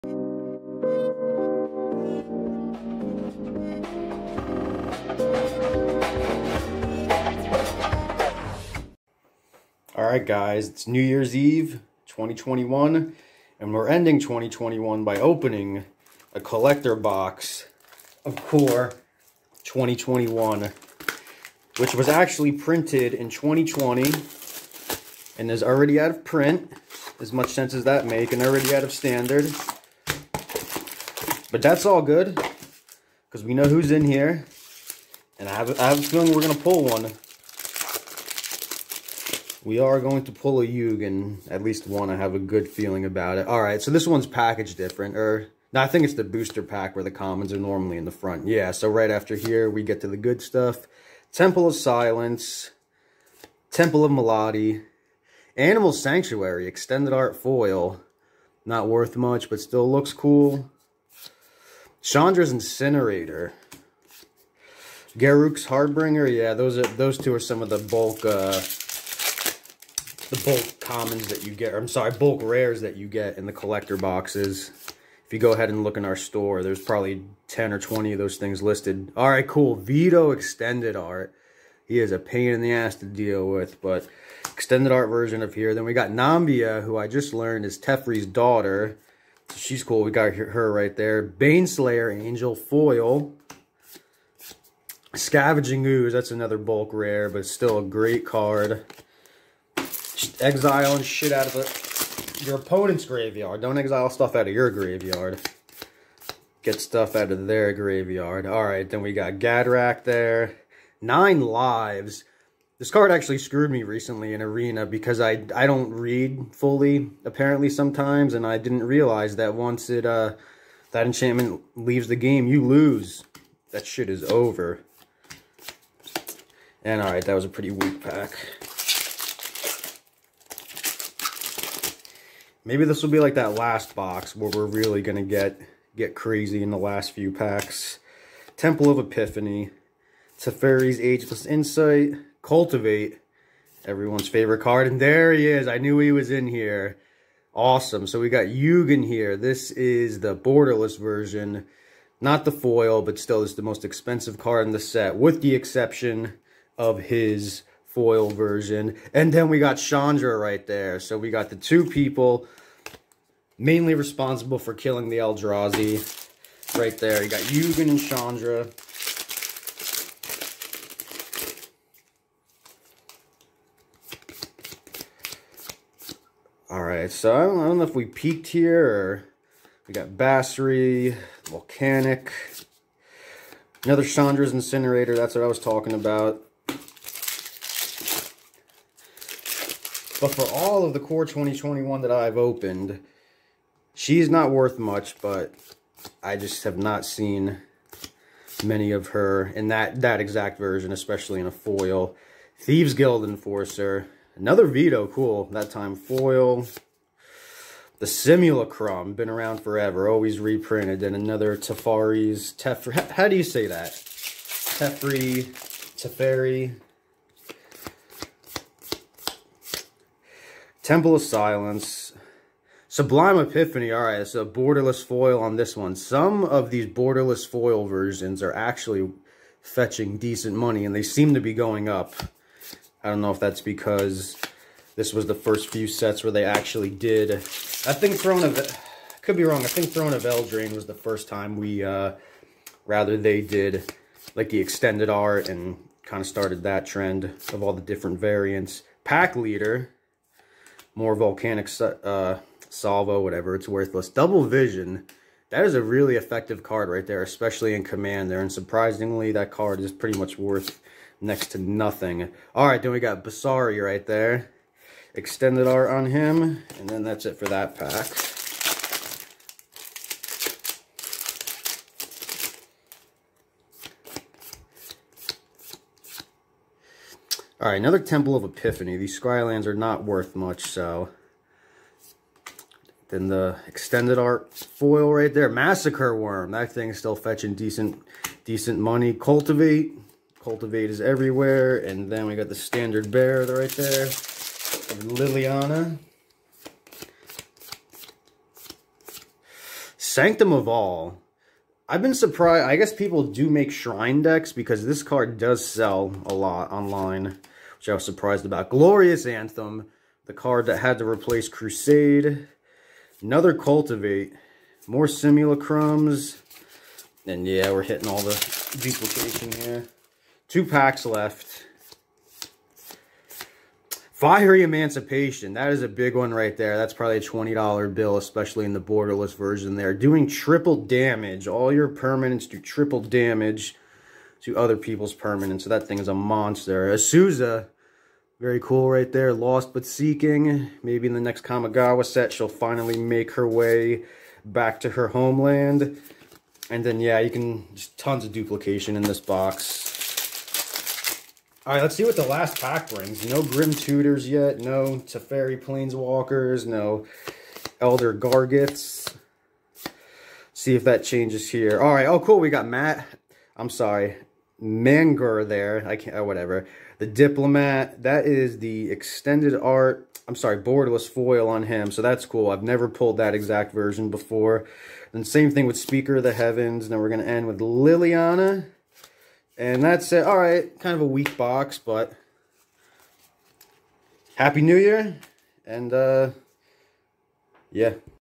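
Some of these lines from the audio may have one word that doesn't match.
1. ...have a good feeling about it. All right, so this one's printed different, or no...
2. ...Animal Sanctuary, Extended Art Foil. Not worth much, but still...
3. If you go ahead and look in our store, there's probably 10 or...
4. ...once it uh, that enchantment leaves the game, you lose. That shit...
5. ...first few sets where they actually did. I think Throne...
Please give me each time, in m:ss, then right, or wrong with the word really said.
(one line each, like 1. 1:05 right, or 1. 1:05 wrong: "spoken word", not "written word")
1. 0:42 wrong: "packaged", not "printed"
2. 0:55 right
3. 1:15 right
4. 1:59 right
5. 3:55 right.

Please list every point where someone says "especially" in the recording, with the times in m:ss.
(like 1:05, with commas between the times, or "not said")
3:20, 4:17, 5:28.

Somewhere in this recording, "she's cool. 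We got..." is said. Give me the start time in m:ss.
1:29.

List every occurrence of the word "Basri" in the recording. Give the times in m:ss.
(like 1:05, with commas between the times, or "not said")
3:00, 4:23.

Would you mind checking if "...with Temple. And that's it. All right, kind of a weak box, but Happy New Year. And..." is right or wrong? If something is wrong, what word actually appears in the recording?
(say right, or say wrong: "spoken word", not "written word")
wrong: "Liliana", not "Temple".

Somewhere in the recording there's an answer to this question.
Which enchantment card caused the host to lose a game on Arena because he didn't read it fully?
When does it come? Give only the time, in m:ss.
1:51.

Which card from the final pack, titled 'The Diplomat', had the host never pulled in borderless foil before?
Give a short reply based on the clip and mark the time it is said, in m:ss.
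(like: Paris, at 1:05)
Mangara, at 6:04.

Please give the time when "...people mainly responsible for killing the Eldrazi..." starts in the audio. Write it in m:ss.
2:41.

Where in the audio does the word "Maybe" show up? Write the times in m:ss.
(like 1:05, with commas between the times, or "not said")
2:12, 5:40.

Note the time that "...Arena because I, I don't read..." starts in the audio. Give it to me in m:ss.
1:54.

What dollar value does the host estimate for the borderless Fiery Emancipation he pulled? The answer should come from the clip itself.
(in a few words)
$20.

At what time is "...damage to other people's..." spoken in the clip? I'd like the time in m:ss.
5:32.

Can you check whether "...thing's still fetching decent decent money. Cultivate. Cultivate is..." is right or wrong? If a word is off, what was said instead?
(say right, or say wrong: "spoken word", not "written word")
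right.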